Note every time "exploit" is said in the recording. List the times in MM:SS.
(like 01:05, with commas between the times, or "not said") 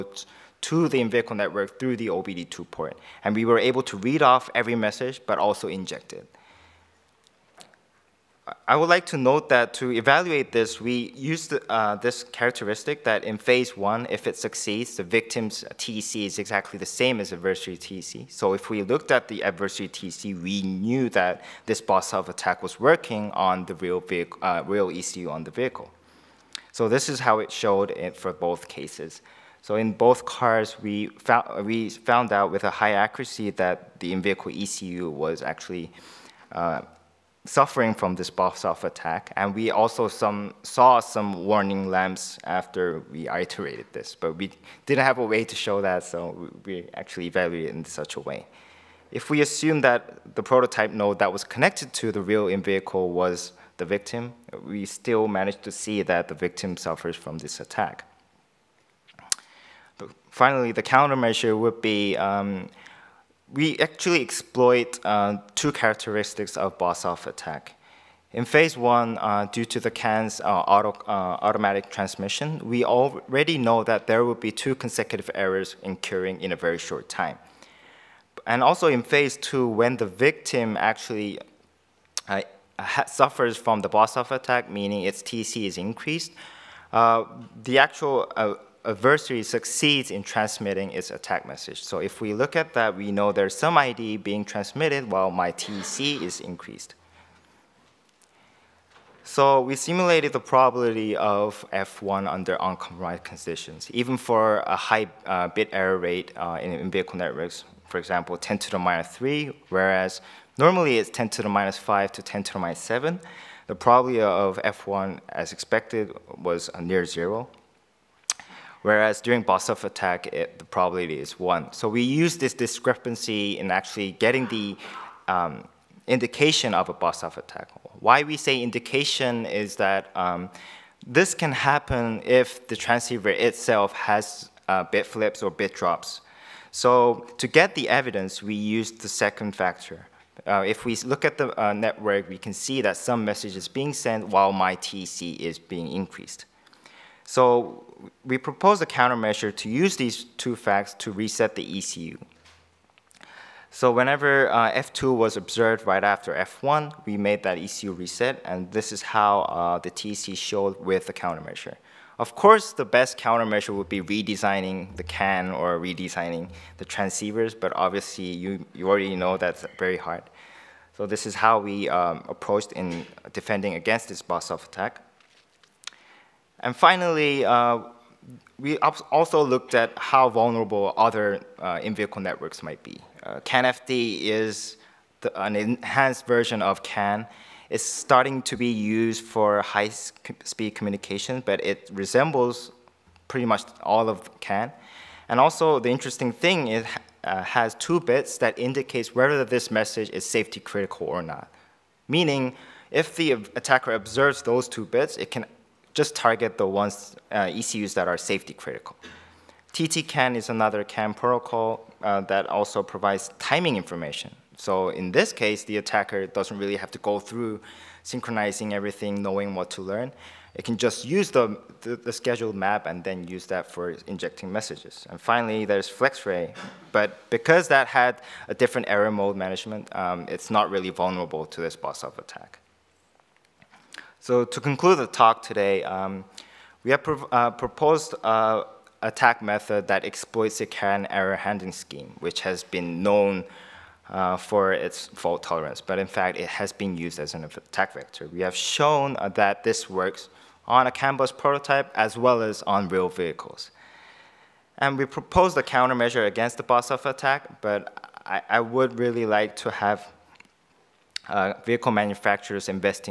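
01:04, 04:00.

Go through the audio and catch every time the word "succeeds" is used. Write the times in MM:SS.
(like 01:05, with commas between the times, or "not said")
00:14, 01:29.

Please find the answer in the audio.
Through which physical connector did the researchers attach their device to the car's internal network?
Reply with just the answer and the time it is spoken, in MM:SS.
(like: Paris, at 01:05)
OBD2 port, at 00:02.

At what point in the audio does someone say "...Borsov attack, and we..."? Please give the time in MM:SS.
00:38.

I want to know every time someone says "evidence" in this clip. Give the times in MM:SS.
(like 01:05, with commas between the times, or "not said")
02:17.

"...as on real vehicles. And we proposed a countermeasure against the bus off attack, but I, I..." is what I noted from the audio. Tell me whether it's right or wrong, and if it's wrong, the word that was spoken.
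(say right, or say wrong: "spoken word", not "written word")
right.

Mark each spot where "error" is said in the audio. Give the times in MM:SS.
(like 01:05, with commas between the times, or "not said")
01:15, 01:45, 03:48, 04:01.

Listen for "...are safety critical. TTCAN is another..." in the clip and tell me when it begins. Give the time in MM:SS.
03:28.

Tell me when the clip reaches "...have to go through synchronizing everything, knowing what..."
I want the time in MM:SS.
03:36.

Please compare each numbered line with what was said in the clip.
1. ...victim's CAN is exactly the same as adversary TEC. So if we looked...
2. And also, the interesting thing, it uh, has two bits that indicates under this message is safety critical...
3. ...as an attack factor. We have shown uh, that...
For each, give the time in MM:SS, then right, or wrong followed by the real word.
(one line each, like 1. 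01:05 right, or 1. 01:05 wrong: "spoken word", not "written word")
1. 00:15 wrong: "TEC", not "CAN"
2. 03:15 wrong: "whether", not "under"
3. 04:07 wrong: "vector", not "factor".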